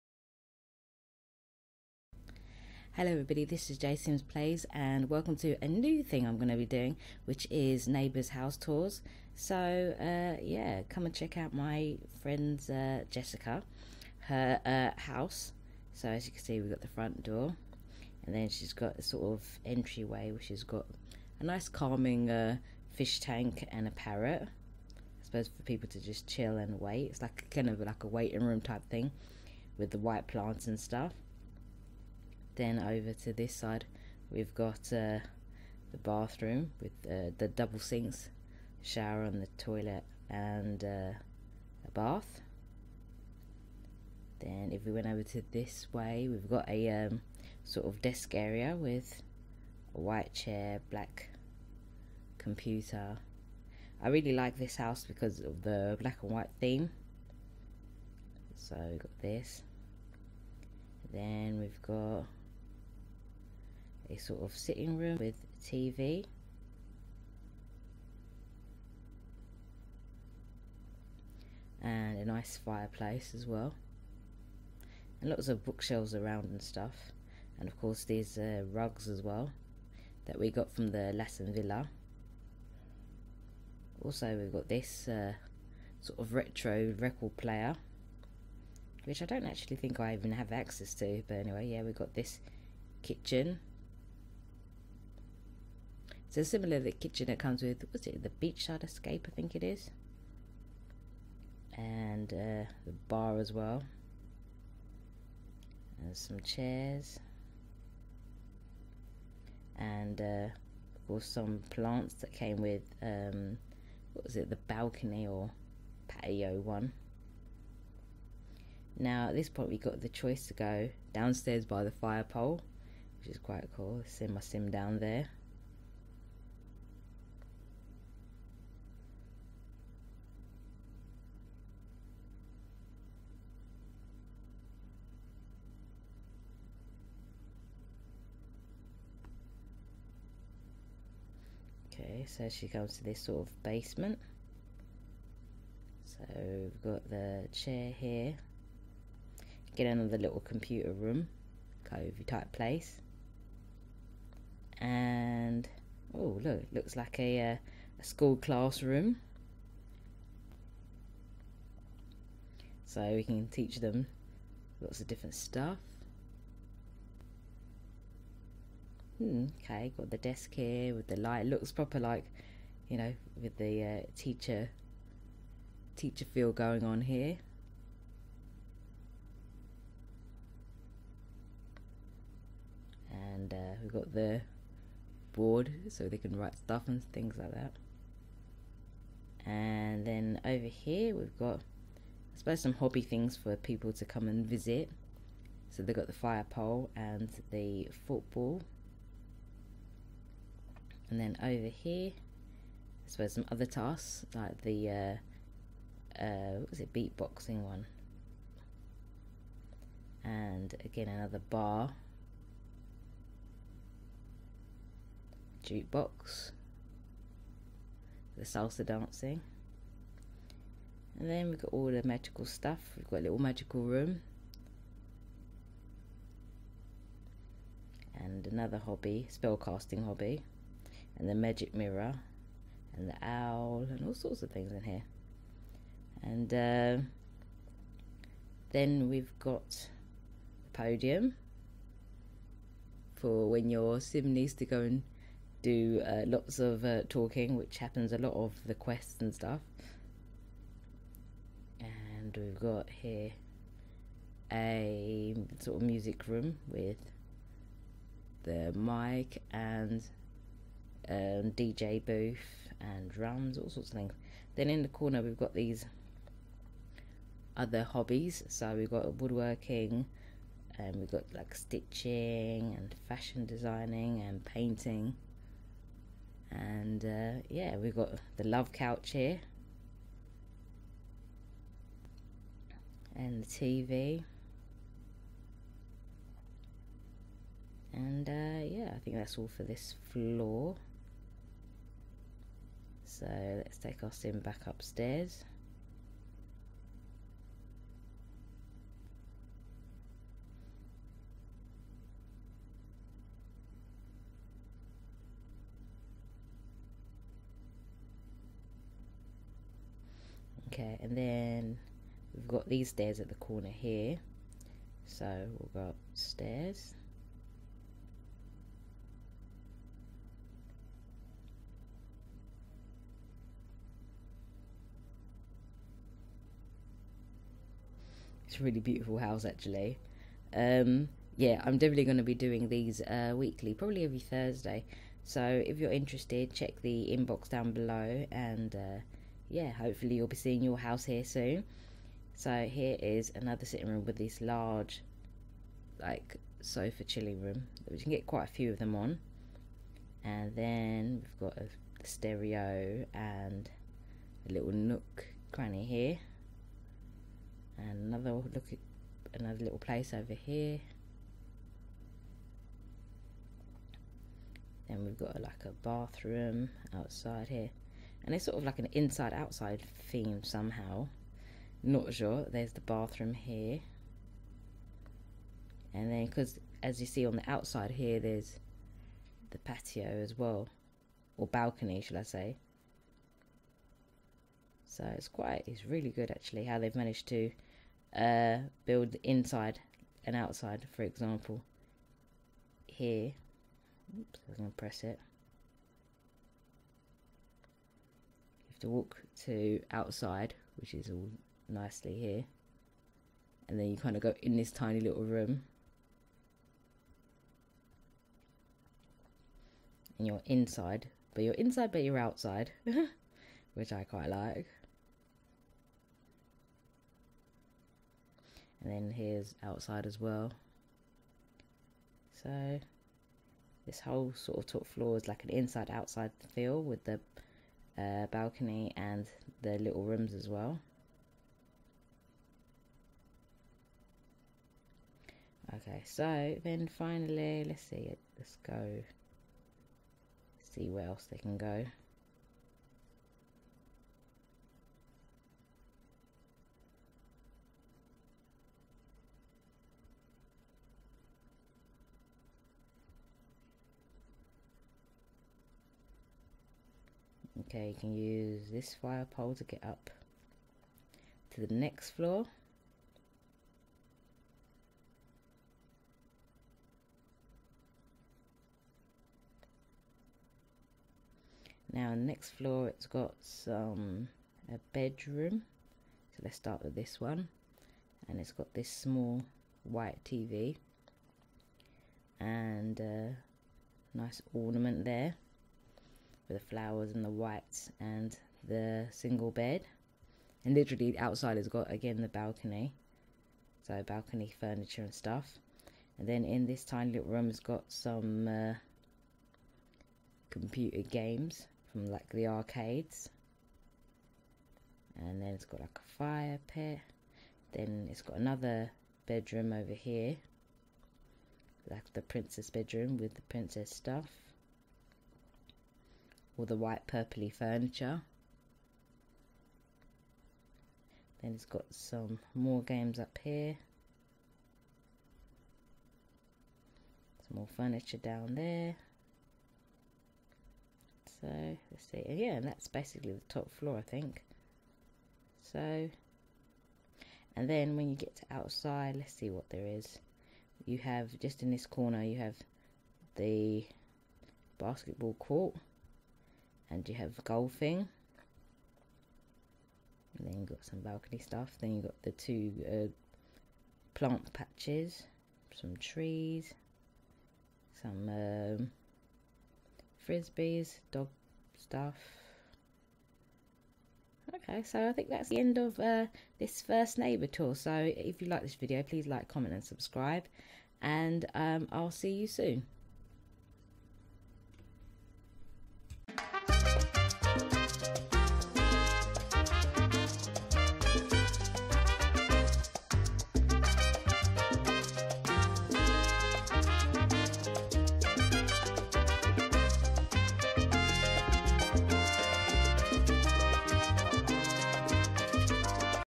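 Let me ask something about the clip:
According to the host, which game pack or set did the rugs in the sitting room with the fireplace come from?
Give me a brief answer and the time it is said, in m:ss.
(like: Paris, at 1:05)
Lassen Villa, at 1:21.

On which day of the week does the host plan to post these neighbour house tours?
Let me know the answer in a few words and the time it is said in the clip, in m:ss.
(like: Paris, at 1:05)
Thursday, at 5:34.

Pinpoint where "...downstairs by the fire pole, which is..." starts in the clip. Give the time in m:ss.
2:01.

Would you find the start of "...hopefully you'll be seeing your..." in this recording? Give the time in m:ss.
5:39.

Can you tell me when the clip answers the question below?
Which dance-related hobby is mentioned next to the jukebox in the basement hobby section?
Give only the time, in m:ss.
3:38.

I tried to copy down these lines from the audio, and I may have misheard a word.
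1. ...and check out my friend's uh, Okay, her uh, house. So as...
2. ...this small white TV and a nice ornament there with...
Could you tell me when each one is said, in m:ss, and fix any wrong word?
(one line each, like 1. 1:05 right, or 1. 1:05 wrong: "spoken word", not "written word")
1. 0:11 wrong: "Jessica", not "Okay"
2. 7:58 right.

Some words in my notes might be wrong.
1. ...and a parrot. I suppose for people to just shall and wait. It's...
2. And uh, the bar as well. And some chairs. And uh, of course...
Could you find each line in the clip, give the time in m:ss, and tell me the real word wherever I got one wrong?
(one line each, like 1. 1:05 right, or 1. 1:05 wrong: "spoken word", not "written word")
1. 0:23 wrong: "chill", not "shall"
2. 1:41 right.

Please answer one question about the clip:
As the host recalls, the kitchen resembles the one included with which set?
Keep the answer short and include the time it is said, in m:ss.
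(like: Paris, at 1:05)
Beachside Escape, at 1:38.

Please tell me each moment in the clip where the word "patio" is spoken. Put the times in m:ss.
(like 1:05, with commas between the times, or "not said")
1:56, 6:19.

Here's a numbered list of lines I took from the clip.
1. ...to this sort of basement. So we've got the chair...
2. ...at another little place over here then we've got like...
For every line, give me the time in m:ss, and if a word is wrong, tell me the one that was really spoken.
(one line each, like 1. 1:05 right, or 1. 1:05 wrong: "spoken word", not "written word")
1. 2:22 right
2. 5:59 right.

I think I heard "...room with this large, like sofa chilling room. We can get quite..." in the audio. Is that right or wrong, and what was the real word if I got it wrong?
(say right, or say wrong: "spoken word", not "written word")
right.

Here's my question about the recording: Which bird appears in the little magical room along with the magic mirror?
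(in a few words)
Owl.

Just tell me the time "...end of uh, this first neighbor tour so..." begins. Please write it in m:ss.
9:25.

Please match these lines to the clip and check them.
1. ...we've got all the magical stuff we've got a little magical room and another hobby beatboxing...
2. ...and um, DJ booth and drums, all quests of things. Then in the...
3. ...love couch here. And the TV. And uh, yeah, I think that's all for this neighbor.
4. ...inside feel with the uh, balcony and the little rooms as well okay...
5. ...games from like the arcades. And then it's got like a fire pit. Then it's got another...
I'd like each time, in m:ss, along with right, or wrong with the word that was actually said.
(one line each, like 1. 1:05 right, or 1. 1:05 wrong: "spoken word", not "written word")
1. 3:41 wrong: "spellcasting", not "beatboxing"
2. 4:19 wrong: "sorts", not "quests"
3. 4:38 wrong: "floor", not "neighbor"
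4. 7:05 wrong: "outside", not "inside"
5. 8:21 right.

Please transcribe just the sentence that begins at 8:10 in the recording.
And literally outside it's got again the balcony.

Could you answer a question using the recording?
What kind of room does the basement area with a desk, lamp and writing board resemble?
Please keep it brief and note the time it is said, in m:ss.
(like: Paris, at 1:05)
School classroom, at 2:38.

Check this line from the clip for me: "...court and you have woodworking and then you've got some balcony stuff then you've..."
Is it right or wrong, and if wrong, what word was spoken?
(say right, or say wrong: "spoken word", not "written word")
wrong: "golfing", not "woodworking".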